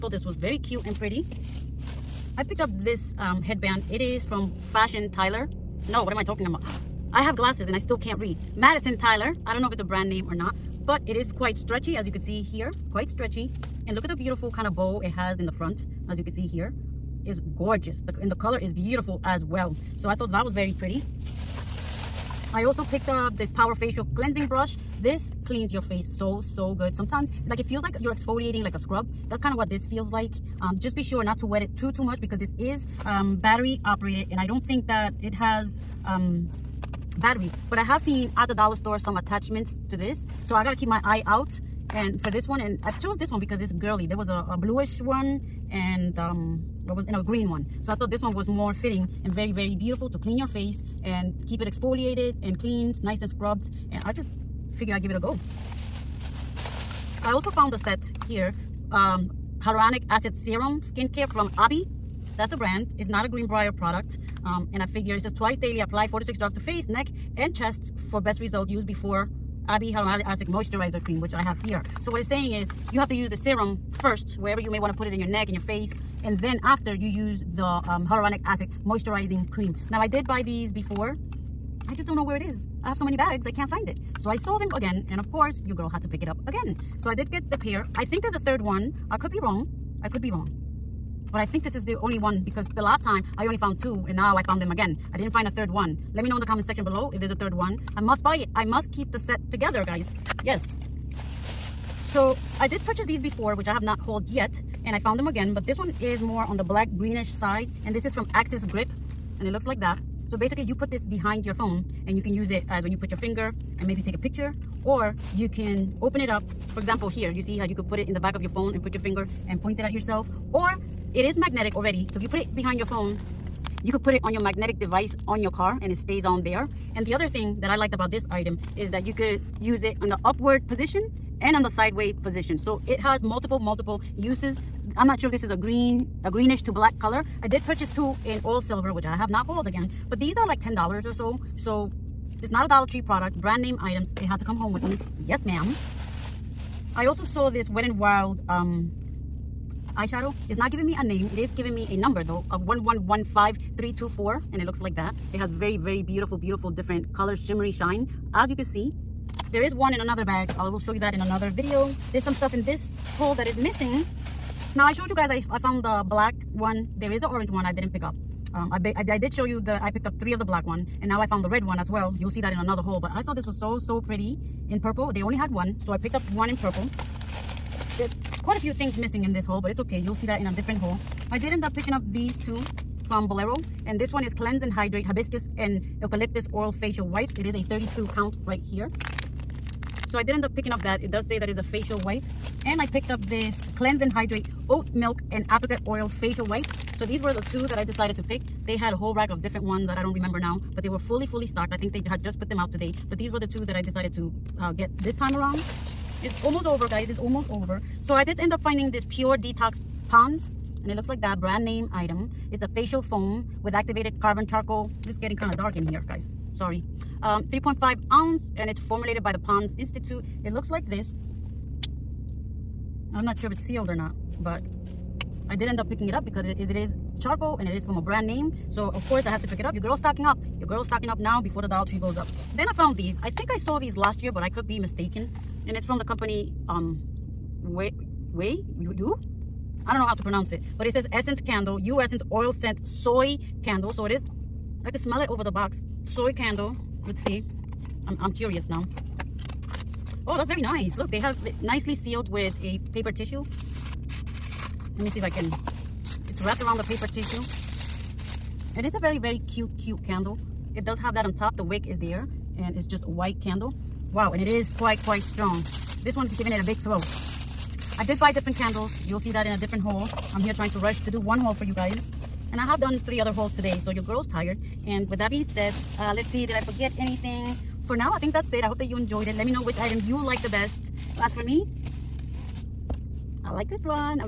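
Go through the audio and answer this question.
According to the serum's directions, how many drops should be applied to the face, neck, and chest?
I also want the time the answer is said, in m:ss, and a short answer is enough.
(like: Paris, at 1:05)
4 to 6, at 1:06.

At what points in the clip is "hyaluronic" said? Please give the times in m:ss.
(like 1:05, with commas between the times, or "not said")
0:59, 1:09, 1:18.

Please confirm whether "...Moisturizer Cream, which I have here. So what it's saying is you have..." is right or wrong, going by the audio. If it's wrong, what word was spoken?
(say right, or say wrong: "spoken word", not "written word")
right.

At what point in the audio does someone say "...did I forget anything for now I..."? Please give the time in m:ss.
4:36.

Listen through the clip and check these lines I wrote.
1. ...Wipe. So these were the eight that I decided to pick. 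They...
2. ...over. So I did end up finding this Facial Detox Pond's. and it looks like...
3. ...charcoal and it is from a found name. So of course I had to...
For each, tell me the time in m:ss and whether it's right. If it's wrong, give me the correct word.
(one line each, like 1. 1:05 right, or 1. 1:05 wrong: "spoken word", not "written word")
1. 3:16 wrong: "two", not "eight"
2. 3:27 wrong: "Pure", not "Facial"
3. 3:47 wrong: "brand", not "found".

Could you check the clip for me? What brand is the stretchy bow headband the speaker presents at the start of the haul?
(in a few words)
Madison Tyler.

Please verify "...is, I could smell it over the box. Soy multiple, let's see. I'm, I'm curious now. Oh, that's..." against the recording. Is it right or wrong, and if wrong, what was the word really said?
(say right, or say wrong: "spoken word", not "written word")
wrong: "candle", not "multiple".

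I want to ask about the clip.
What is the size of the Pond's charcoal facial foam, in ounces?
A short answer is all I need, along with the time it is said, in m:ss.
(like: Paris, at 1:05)
3.5 ounces, at 3:37.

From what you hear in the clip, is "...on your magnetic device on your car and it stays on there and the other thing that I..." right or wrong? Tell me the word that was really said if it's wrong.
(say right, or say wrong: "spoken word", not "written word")
right.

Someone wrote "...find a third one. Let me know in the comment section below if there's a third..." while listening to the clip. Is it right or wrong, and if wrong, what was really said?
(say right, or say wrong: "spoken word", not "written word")
right.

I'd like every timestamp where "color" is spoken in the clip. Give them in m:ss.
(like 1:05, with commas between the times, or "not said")
0:18, 2:16, 2:37.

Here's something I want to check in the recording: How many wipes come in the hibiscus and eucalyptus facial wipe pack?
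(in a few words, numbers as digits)
32.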